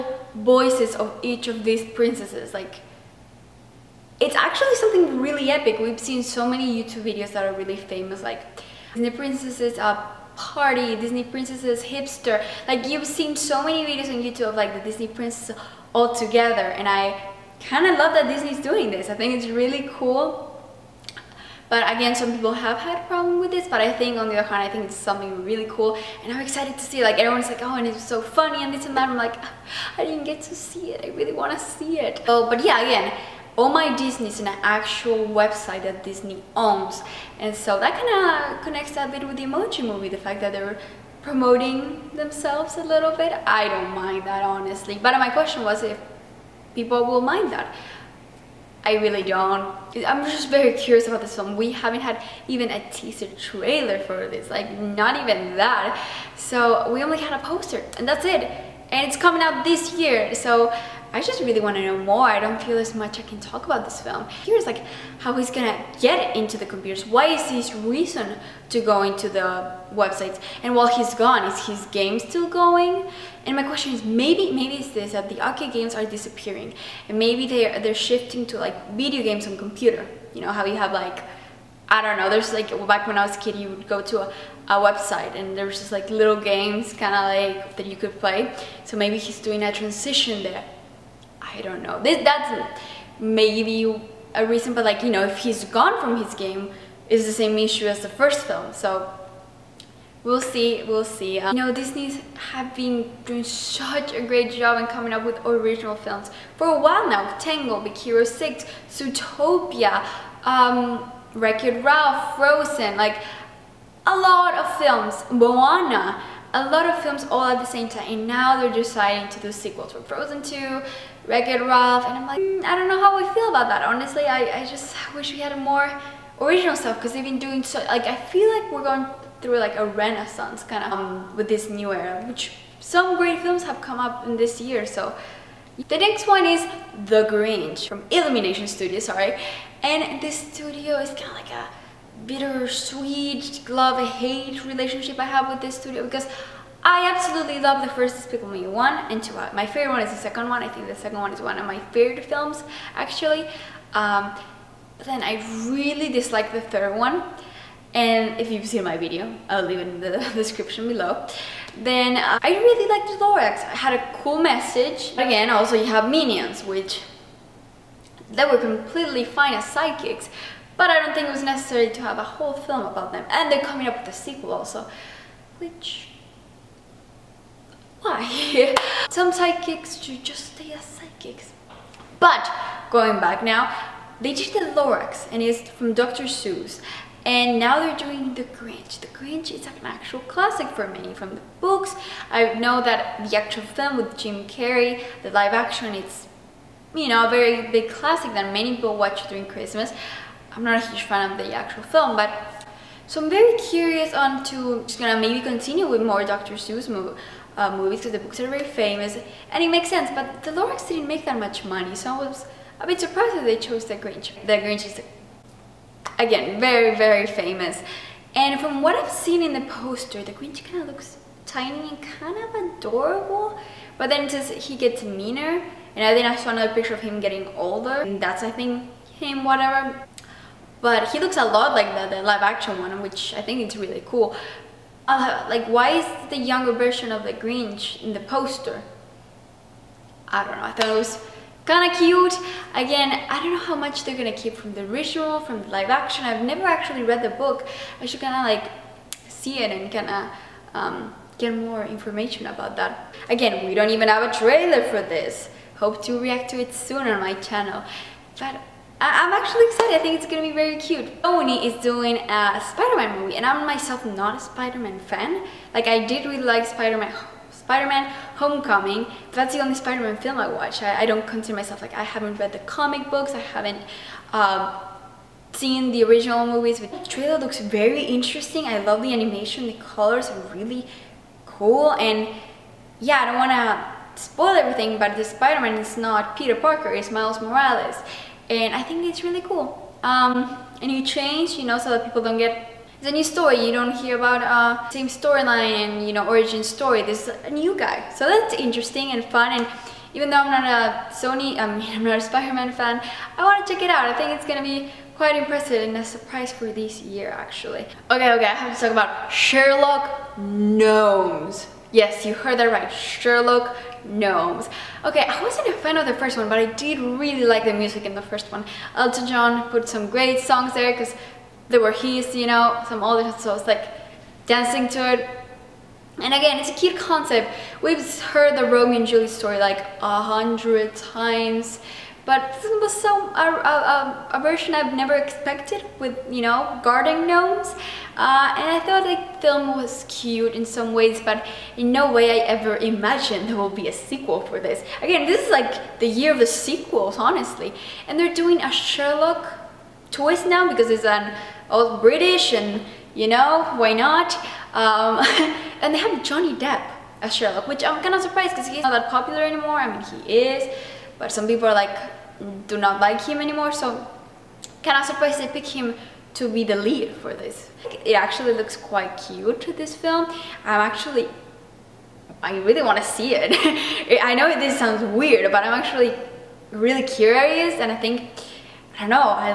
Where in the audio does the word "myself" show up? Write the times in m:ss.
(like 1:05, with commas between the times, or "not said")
4:23, 4:31.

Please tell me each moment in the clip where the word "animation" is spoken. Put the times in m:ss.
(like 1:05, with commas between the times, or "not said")
4:39.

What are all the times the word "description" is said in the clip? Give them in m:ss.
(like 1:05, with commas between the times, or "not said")
2:40.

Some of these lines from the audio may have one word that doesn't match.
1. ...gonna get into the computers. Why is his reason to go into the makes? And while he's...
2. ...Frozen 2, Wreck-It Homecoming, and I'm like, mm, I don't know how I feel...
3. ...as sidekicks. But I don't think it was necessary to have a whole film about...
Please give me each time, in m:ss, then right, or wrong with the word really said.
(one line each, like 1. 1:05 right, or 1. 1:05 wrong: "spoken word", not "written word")
1. 1:05 wrong: "websites", not "makes"
2. 2:00 wrong: "Ralph", not "Homecoming"
3. 2:49 right.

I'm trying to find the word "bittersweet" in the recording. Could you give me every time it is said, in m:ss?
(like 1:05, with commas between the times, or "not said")
2:22.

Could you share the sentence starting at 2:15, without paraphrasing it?
The next one is The Grinch from Illumination Studio, sorry.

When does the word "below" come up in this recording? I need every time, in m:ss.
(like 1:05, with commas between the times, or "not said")
2:40.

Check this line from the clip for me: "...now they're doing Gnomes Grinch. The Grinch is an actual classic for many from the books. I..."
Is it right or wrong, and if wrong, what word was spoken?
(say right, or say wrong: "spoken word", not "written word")
wrong: "The", not "Gnomes".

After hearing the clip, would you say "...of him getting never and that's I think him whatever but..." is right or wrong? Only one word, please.
wrong.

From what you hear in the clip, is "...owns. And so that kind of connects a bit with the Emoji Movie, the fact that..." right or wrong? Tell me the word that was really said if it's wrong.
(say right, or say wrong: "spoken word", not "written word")
right.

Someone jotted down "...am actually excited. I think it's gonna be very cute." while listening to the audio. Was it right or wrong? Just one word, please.
right.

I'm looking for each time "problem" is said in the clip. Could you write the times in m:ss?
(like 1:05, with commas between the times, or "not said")
0:23.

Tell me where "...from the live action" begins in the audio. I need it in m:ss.
4:05.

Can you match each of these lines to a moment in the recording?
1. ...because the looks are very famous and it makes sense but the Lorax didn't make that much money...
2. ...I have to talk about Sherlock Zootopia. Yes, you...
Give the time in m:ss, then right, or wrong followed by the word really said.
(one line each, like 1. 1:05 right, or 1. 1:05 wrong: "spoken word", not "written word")
1. 3:27 wrong: "books", not "looks"
2. 5:08 wrong: "Gnomes", not "Zootopia".